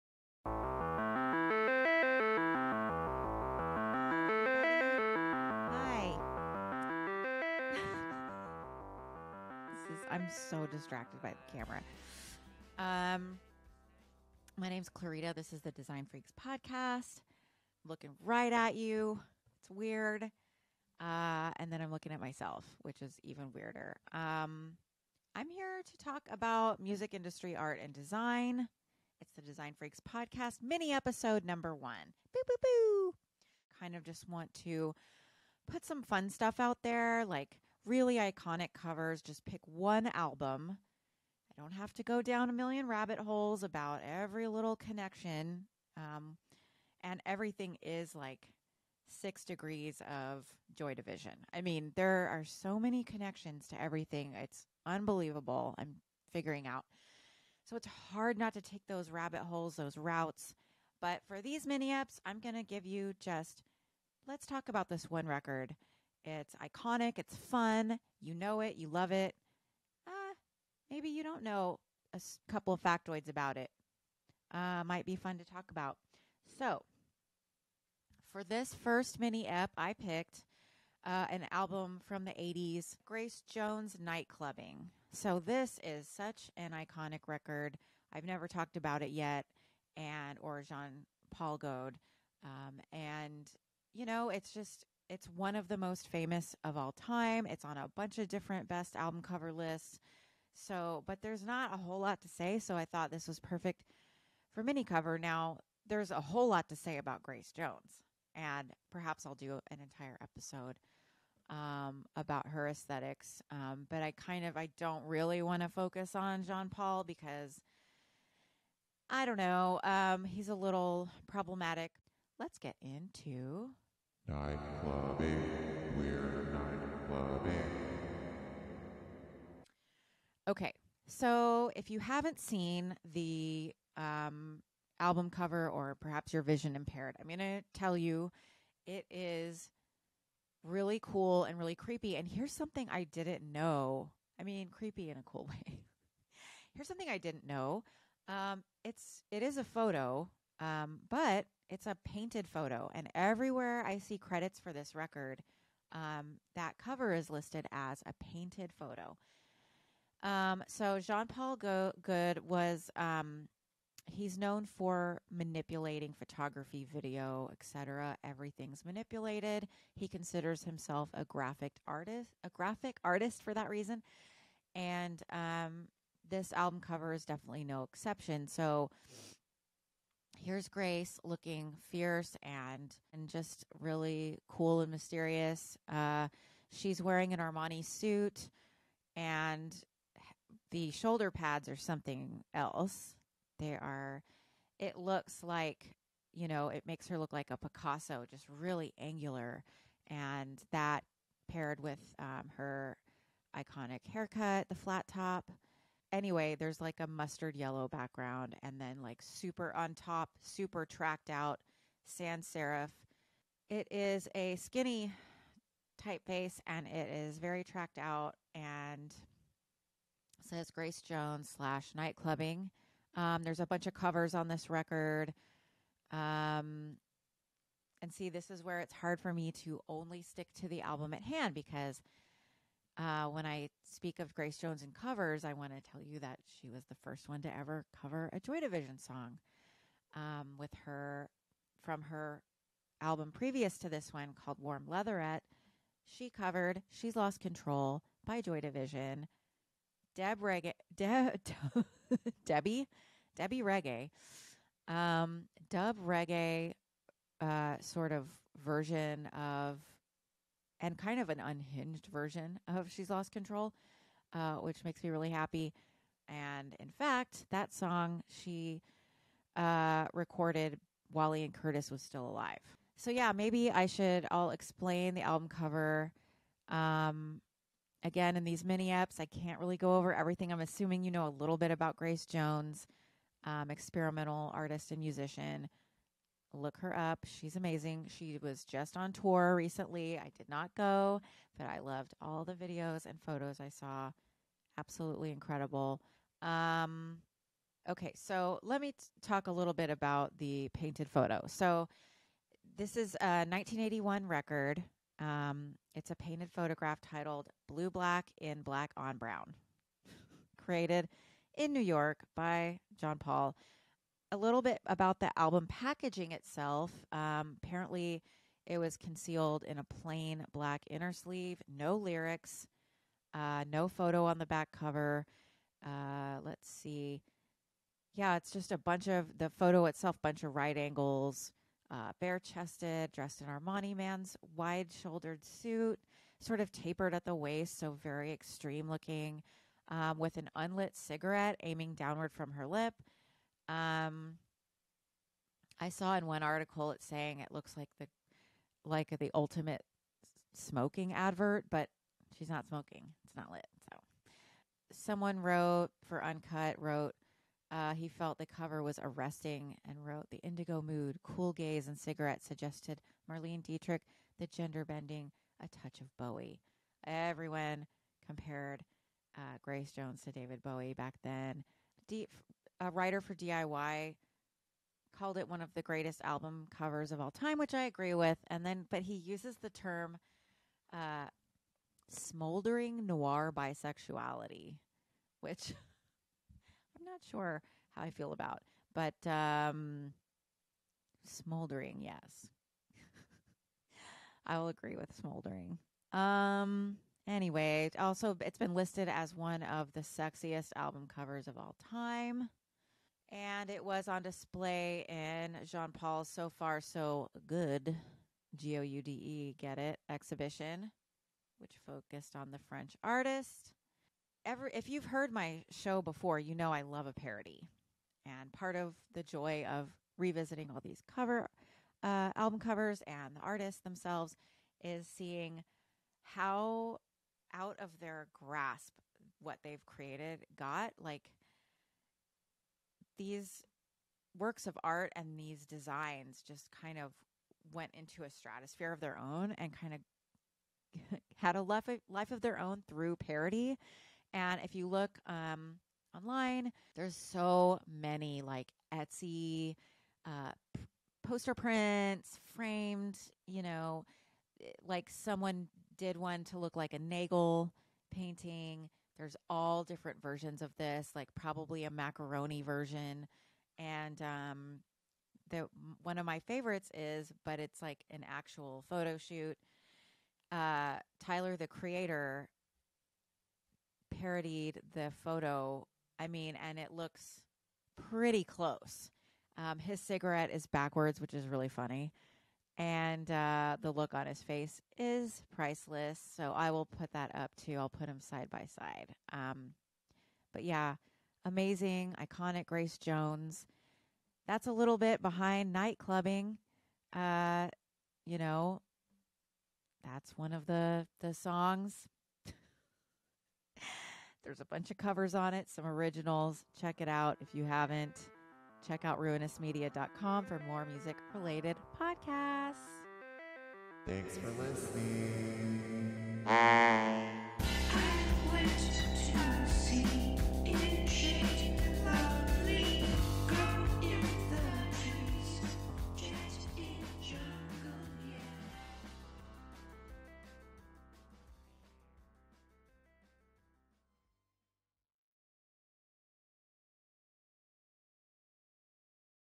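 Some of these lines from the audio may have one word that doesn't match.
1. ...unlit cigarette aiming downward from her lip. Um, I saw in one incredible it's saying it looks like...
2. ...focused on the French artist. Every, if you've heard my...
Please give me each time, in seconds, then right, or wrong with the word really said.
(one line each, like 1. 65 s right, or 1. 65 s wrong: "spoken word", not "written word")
1. 340 s wrong: "article", not "incredible"
2. 411 s right.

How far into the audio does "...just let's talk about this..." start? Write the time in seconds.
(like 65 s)
63 s.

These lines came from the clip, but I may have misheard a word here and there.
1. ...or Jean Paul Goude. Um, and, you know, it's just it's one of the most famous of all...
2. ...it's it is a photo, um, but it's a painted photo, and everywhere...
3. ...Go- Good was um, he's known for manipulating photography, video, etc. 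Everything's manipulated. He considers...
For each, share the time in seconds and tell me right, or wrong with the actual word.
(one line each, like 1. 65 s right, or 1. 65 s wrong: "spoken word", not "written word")
1. 90 s right
2. 148 s right
3. 161 s right.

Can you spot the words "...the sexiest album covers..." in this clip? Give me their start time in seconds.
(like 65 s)
399 s.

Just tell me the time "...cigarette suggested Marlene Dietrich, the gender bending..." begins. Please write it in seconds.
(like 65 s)
361 s.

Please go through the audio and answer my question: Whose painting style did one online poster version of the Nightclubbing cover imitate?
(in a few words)
Nagel.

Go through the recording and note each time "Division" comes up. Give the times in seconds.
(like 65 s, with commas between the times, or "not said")
50 s, 238 s, 248 s.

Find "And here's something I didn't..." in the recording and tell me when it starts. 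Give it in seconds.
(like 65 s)
142 s.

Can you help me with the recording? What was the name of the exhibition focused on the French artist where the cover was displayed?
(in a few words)
So Far So Good.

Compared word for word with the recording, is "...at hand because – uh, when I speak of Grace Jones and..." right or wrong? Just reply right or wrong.
right.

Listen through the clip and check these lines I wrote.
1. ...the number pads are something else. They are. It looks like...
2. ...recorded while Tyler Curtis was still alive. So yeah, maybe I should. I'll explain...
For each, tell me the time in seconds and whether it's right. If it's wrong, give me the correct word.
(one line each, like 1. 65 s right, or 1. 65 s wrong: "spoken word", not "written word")
1. 190 s wrong: "shoulder", not "number"
2. 270 s wrong: "Ian", not "Tyler".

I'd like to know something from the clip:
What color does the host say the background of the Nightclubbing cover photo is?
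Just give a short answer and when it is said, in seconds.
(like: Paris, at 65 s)
Mustard yellow, at 207 s.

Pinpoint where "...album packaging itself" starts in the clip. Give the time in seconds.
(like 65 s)
315 s.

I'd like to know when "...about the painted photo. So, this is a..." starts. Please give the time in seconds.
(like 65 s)
299 s.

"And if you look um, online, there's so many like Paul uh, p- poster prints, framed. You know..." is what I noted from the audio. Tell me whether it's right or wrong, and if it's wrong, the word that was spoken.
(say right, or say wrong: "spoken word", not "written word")
wrong: "Etsy", not "Paul".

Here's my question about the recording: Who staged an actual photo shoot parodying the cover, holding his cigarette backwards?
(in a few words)
Tyler, the Creator.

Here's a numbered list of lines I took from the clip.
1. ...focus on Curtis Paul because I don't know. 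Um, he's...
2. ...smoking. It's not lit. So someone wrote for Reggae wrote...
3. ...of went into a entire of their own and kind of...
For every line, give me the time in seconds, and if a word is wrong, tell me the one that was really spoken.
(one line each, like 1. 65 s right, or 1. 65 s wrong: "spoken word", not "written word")
1. 115 s wrong: "Jean", not "Curtis"
2. 352 s wrong: "Uncut", not "Reggae"
3. 436 s wrong: "stratosphere", not "entire".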